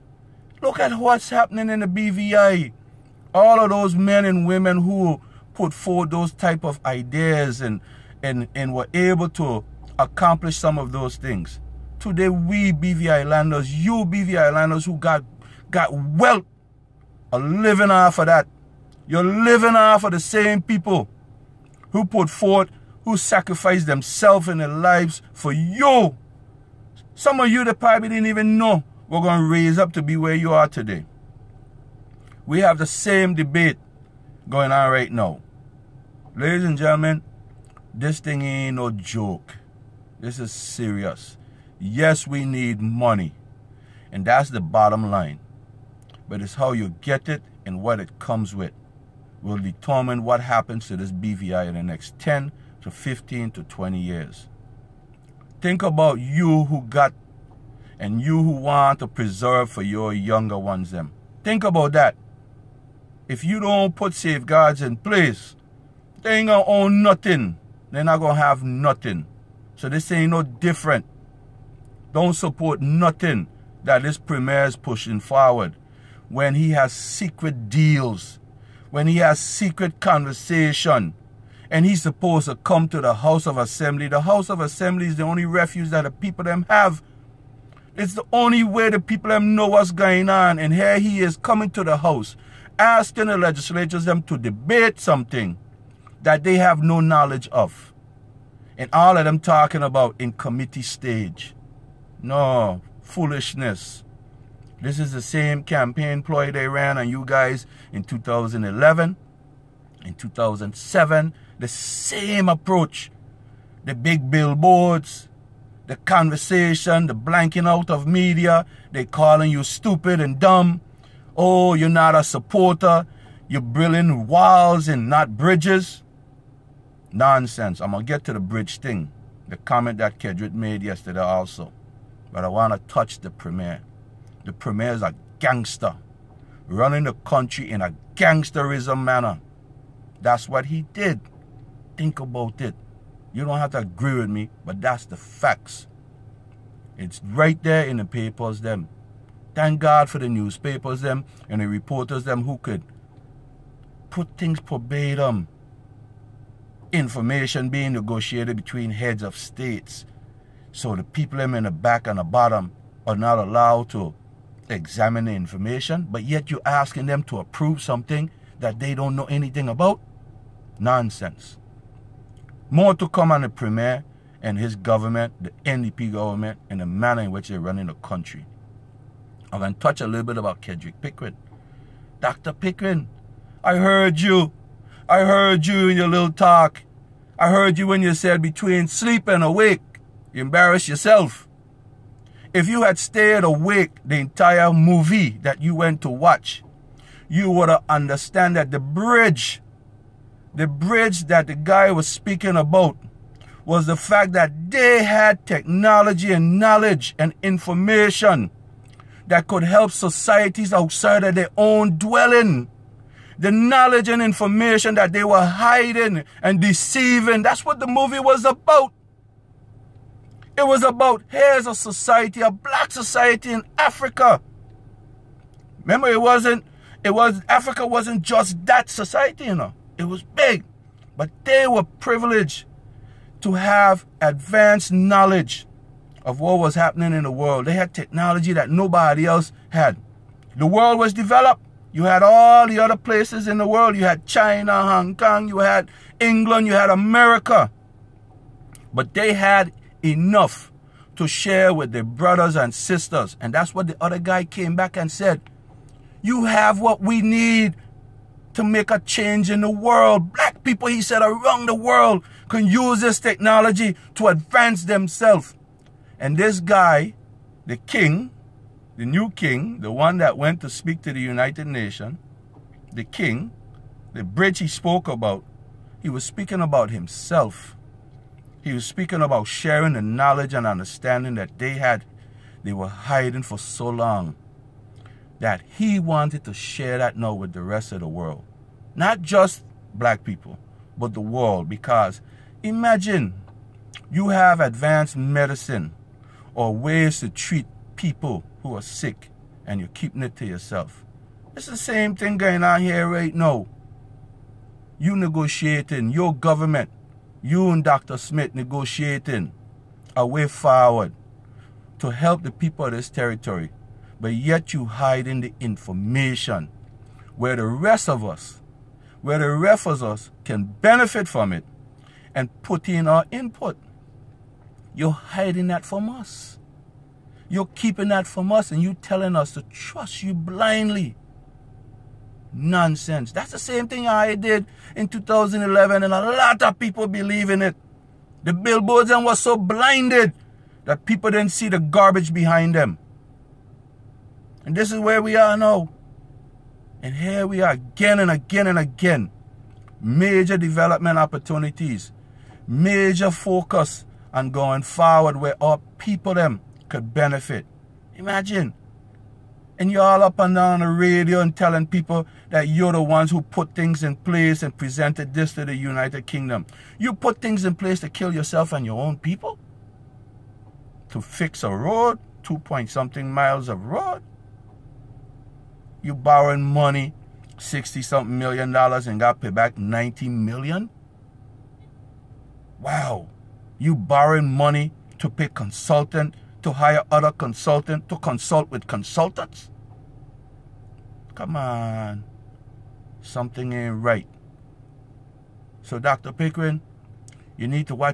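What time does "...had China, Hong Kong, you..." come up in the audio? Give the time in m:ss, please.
4:04.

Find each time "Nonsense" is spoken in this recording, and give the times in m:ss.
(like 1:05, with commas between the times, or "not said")
2:07, 2:50, 5:32.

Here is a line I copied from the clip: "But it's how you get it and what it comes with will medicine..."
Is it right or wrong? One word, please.
wrong.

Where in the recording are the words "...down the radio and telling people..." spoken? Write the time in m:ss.
6:00.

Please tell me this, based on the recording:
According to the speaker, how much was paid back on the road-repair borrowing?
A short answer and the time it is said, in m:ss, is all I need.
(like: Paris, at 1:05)
90 million, at 6:19.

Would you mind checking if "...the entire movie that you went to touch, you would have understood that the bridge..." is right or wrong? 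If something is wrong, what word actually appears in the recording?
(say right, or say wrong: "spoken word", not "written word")
wrong: "watch", not "touch".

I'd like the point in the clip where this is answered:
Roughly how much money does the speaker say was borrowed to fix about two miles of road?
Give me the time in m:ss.
6:17.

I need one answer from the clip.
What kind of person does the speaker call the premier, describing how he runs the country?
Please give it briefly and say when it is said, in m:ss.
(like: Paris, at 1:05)
A gangster, at 2:15.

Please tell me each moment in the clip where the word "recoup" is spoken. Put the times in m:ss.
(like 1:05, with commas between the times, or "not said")
not said.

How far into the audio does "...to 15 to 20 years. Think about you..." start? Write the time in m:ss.
0:52.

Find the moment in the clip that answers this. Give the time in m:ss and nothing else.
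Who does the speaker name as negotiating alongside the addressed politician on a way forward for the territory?
5:07.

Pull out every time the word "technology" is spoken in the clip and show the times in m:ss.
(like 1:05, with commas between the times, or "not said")
3:25, 3:57, 4:23.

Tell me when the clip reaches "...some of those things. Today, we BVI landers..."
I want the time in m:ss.
0:10.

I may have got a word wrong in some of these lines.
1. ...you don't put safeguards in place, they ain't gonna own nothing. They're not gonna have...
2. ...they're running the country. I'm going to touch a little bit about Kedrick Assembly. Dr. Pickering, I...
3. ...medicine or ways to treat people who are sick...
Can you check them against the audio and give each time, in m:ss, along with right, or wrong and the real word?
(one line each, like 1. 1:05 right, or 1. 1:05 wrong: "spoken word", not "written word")
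1. 1:03 right
2. 2:57 wrong: "Pickering", not "Assembly"
3. 4:55 right.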